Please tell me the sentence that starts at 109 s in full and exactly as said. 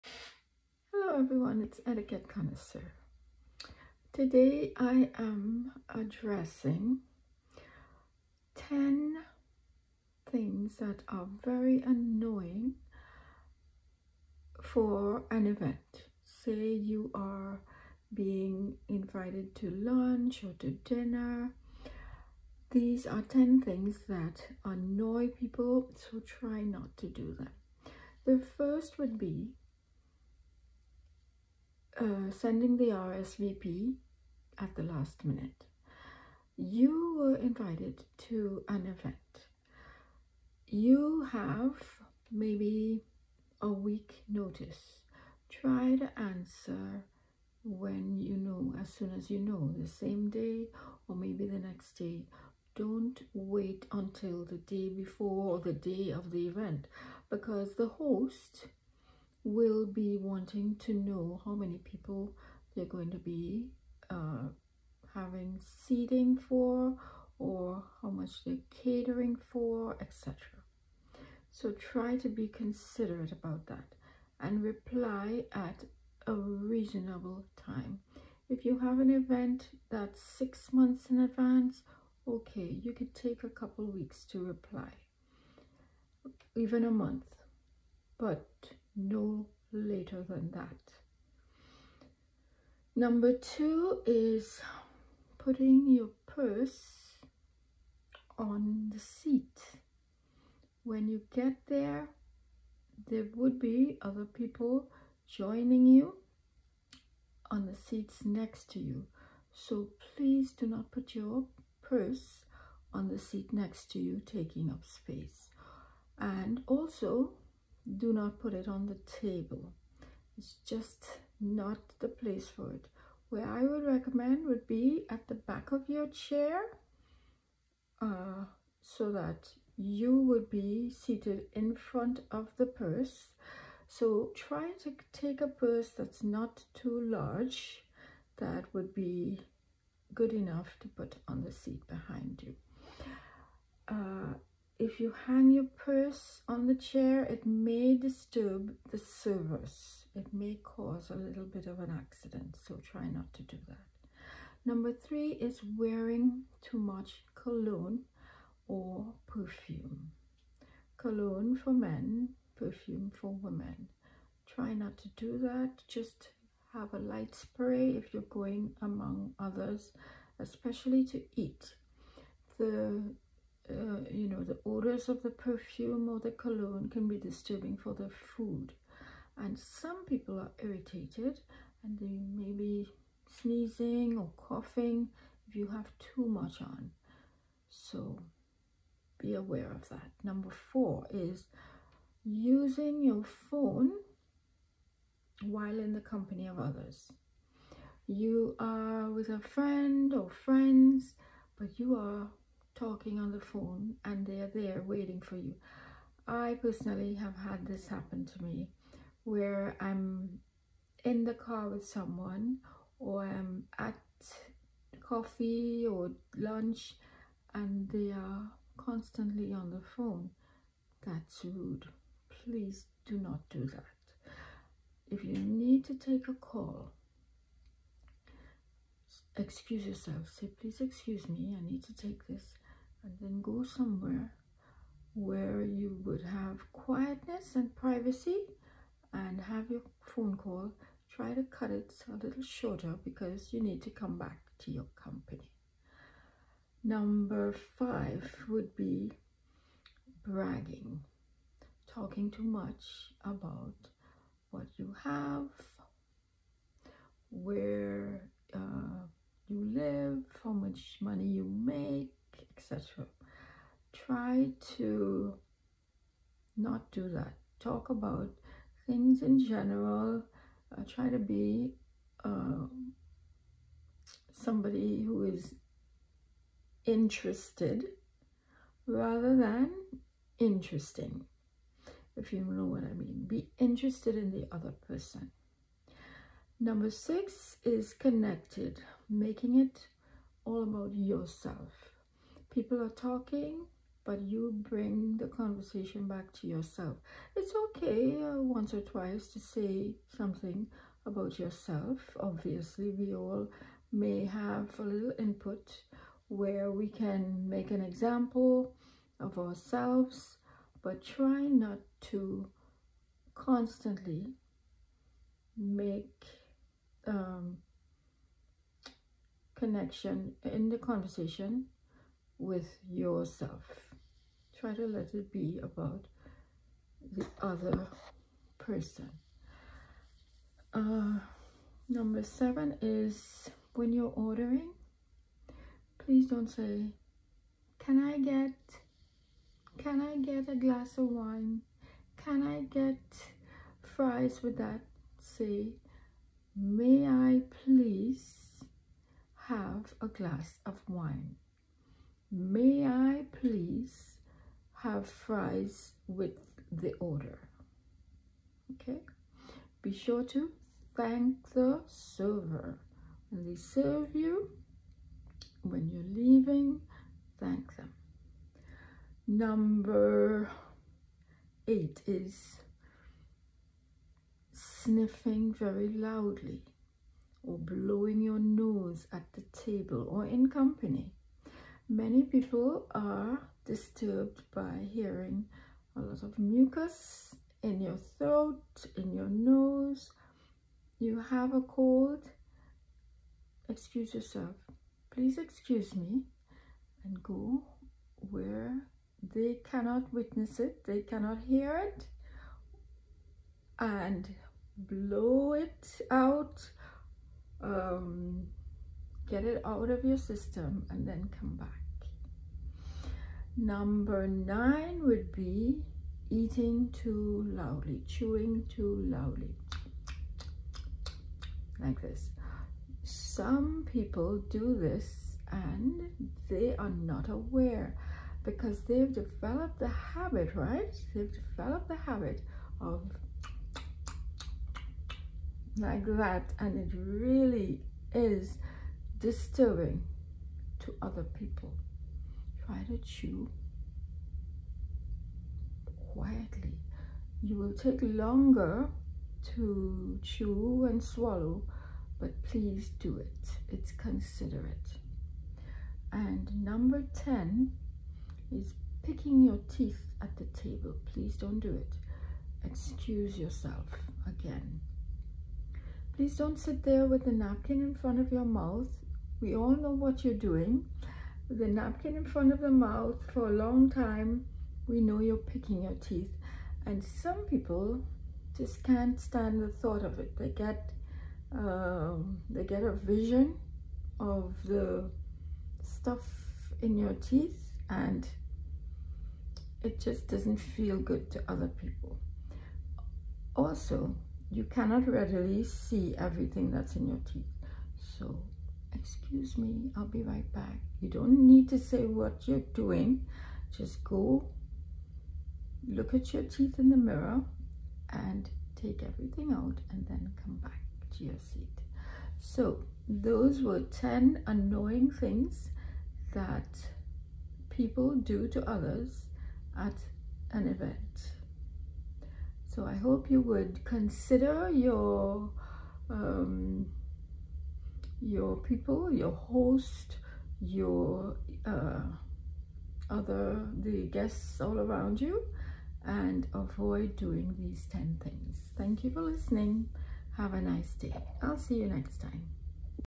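So please do not put your purse on the seat next to you, taking up space.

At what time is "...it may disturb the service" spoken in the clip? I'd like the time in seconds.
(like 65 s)
147 s.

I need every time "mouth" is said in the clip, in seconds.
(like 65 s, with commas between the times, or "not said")
468 s, 472 s.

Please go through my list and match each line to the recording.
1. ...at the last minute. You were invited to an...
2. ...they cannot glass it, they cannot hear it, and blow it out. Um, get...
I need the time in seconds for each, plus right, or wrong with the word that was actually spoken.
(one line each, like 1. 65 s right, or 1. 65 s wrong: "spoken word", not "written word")
1. 34 s right
2. 399 s wrong: "witness", not "glass".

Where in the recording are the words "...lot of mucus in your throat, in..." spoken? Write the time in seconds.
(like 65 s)
385 s.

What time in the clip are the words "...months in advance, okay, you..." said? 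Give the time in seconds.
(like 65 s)
80 s.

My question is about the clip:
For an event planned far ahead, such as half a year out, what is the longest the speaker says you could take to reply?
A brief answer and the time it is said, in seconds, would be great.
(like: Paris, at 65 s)
a month, at 86 s.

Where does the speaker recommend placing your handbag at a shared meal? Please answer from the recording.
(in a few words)
back of your chair.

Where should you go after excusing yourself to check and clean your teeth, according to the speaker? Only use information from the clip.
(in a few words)
the mirror.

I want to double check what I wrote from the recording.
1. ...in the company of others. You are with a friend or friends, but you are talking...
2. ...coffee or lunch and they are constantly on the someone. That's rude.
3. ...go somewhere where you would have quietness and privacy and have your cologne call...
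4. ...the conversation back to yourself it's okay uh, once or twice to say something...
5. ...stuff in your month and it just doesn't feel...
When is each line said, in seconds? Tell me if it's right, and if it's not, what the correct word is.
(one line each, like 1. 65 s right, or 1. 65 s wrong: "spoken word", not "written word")
1. 195 s right
2. 214 s wrong: "phone", not "someone"
3. 233 s wrong: "phone", not "cologne"
4. 295 s right
5. 485 s wrong: "teeth", not "month".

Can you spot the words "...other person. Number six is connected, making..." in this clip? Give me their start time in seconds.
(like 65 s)
284 s.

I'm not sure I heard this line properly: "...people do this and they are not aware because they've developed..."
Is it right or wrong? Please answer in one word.
right.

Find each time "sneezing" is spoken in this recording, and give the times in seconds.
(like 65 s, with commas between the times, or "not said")
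183 s.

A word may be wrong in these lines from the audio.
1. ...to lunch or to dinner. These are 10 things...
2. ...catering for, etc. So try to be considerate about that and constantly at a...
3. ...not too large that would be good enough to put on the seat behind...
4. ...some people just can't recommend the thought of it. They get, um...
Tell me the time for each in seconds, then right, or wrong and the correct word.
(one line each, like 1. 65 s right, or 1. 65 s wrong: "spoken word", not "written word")
1. 19 s right
2. 68 s wrong: "reply", not "constantly"
3. 136 s right
4. 477 s wrong: "stand", not "recommend".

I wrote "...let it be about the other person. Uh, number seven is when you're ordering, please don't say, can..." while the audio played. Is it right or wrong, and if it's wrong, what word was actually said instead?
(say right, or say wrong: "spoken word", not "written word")
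right.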